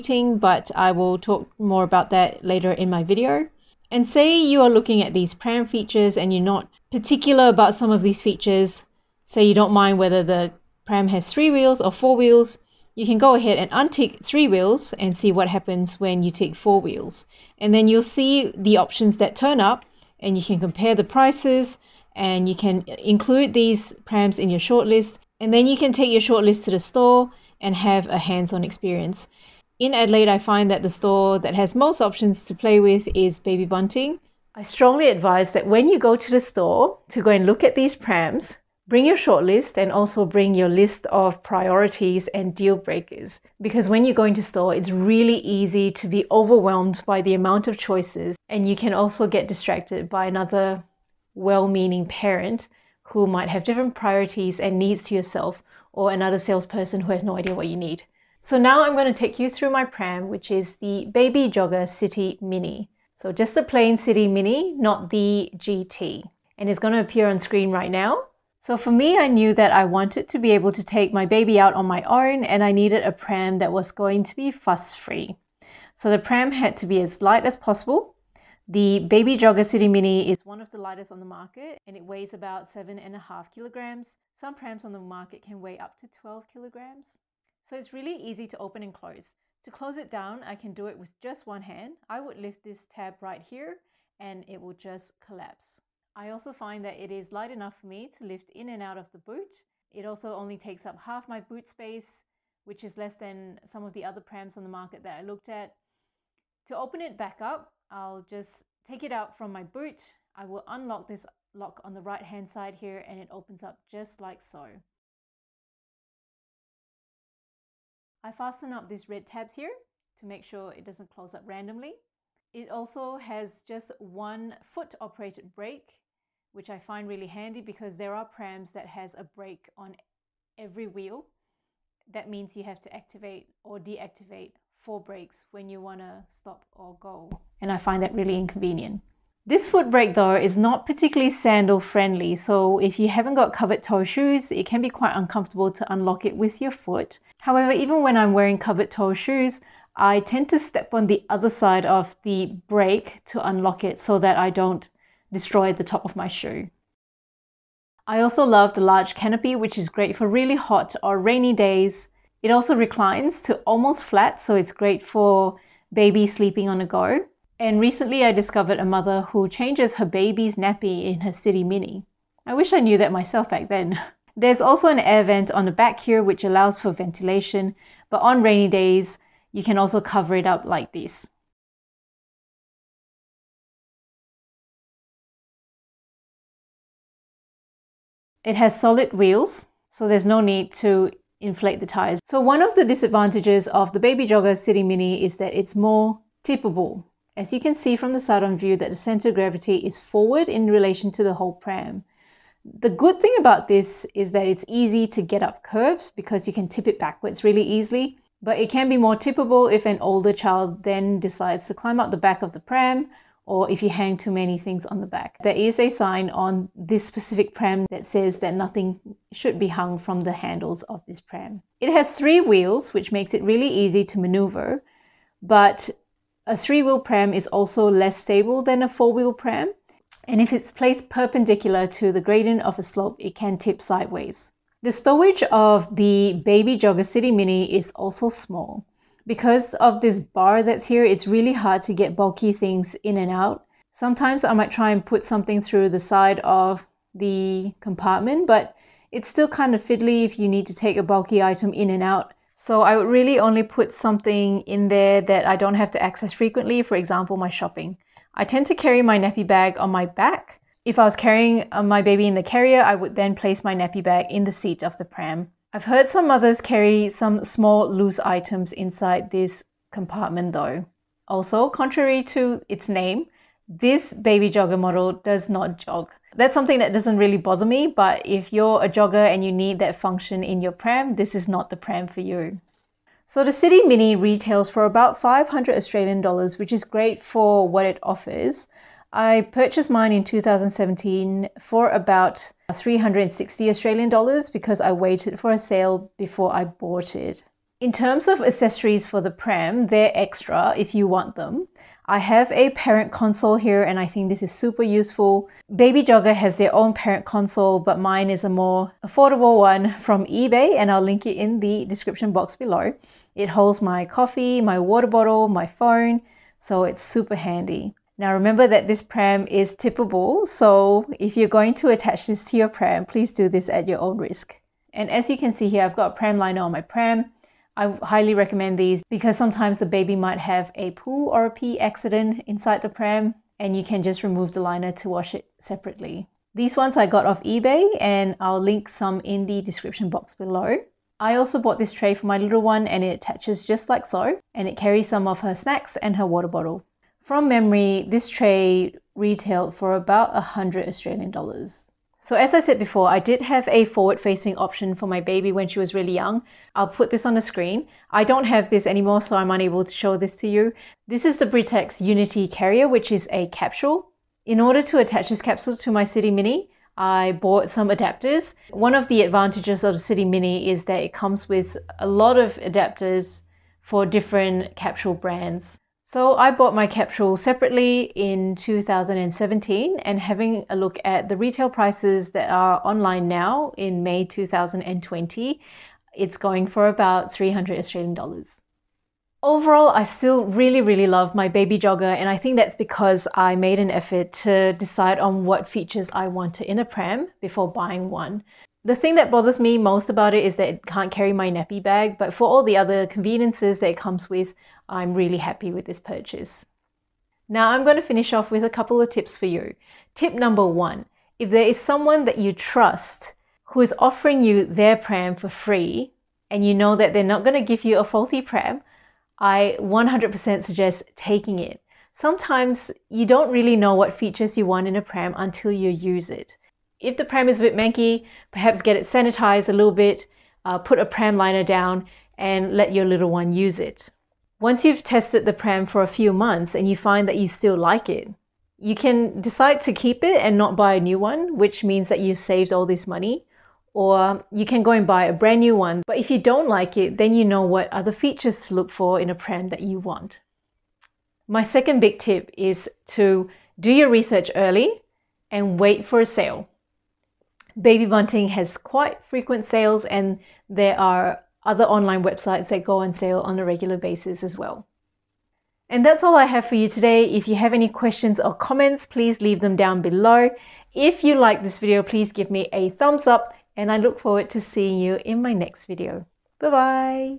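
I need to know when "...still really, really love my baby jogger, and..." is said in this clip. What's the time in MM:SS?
06:30.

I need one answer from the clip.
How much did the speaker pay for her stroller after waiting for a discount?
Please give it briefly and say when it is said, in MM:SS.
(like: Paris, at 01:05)
360 Australian dollars, at 04:52.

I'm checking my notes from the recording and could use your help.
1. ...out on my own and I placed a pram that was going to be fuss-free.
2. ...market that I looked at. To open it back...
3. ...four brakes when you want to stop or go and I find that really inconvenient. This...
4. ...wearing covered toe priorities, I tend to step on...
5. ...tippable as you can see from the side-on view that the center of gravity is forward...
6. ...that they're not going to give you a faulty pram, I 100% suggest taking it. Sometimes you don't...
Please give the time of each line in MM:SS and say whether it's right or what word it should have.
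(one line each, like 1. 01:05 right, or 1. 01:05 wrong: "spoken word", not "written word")
1. 01:11 wrong: "needed", not "placed"
2. 01:44 right
3. 02:14 right
4. 02:28 wrong: "shoes", not "priorities"
5. 03:16 right
6. 06:56 right.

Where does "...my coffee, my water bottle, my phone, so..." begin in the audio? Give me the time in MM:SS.
05:13.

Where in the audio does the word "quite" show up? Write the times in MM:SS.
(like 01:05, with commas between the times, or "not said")
02:24, 07:38.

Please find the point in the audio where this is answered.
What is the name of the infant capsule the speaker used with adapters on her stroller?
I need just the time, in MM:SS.
06:01.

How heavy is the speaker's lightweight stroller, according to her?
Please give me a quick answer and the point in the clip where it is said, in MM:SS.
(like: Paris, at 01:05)
7.5 kilograms, at 01:22.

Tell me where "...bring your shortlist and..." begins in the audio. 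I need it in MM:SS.
00:38.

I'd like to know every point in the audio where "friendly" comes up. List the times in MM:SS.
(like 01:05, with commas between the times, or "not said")
02:21.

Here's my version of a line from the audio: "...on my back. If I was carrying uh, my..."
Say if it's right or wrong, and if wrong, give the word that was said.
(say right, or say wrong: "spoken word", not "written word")
right.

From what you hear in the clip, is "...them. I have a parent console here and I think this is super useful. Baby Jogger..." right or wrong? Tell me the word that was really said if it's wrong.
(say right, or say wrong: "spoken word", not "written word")
right.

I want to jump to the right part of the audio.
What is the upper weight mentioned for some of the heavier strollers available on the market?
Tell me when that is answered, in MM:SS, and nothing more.
01:26.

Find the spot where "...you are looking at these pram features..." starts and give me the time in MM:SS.
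00:04.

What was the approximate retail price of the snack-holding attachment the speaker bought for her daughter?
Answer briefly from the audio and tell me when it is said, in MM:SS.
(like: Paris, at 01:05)
100 Australian dollars, at 05:50.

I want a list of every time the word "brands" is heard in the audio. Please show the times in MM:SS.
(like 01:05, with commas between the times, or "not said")
06:15, 07:25.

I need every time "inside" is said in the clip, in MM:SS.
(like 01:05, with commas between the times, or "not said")
04:28, 05:32.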